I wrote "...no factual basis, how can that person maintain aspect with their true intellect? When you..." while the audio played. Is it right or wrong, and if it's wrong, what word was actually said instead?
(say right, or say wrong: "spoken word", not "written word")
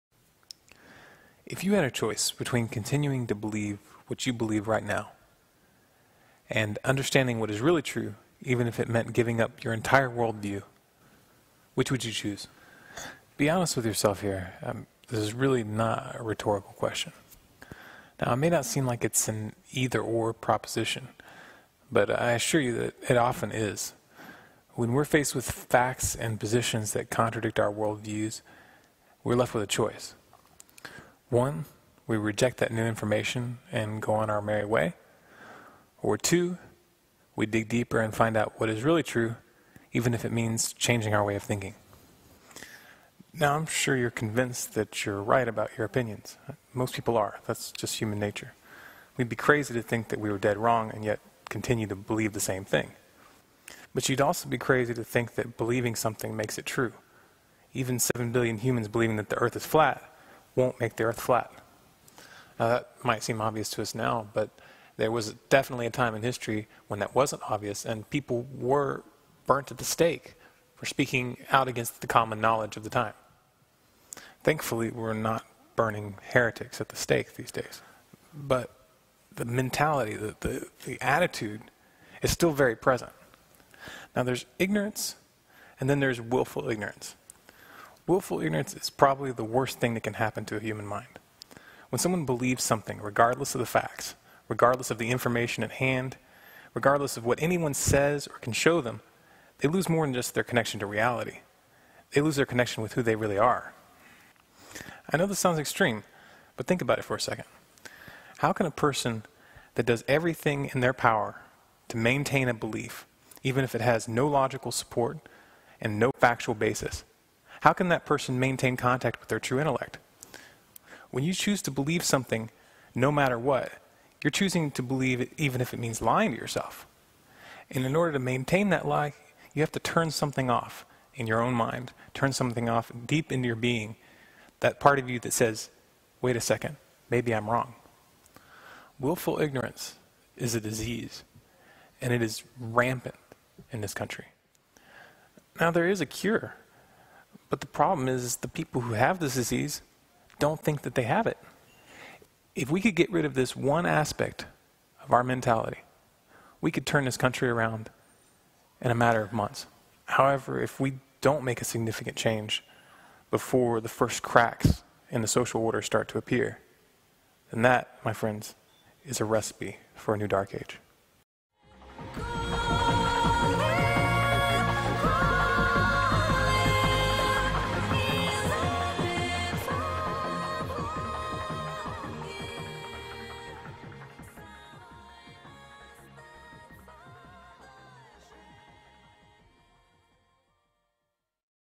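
wrong: "contact", not "aspect".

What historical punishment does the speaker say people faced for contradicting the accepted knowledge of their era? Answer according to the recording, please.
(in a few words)
Burnt at the stake.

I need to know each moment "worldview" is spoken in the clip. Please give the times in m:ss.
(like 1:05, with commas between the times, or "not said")
0:10, 0:27.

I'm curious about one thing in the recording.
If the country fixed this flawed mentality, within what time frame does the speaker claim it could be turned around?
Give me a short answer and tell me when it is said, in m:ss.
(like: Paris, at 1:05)
A matter of months, at 2:38.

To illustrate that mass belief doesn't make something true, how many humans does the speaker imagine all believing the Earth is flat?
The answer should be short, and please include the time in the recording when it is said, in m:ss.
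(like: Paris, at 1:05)
7 billion, at 0:57.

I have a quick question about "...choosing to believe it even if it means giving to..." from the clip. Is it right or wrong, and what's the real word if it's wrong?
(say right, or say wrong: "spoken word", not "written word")
wrong: "lying", not "giving".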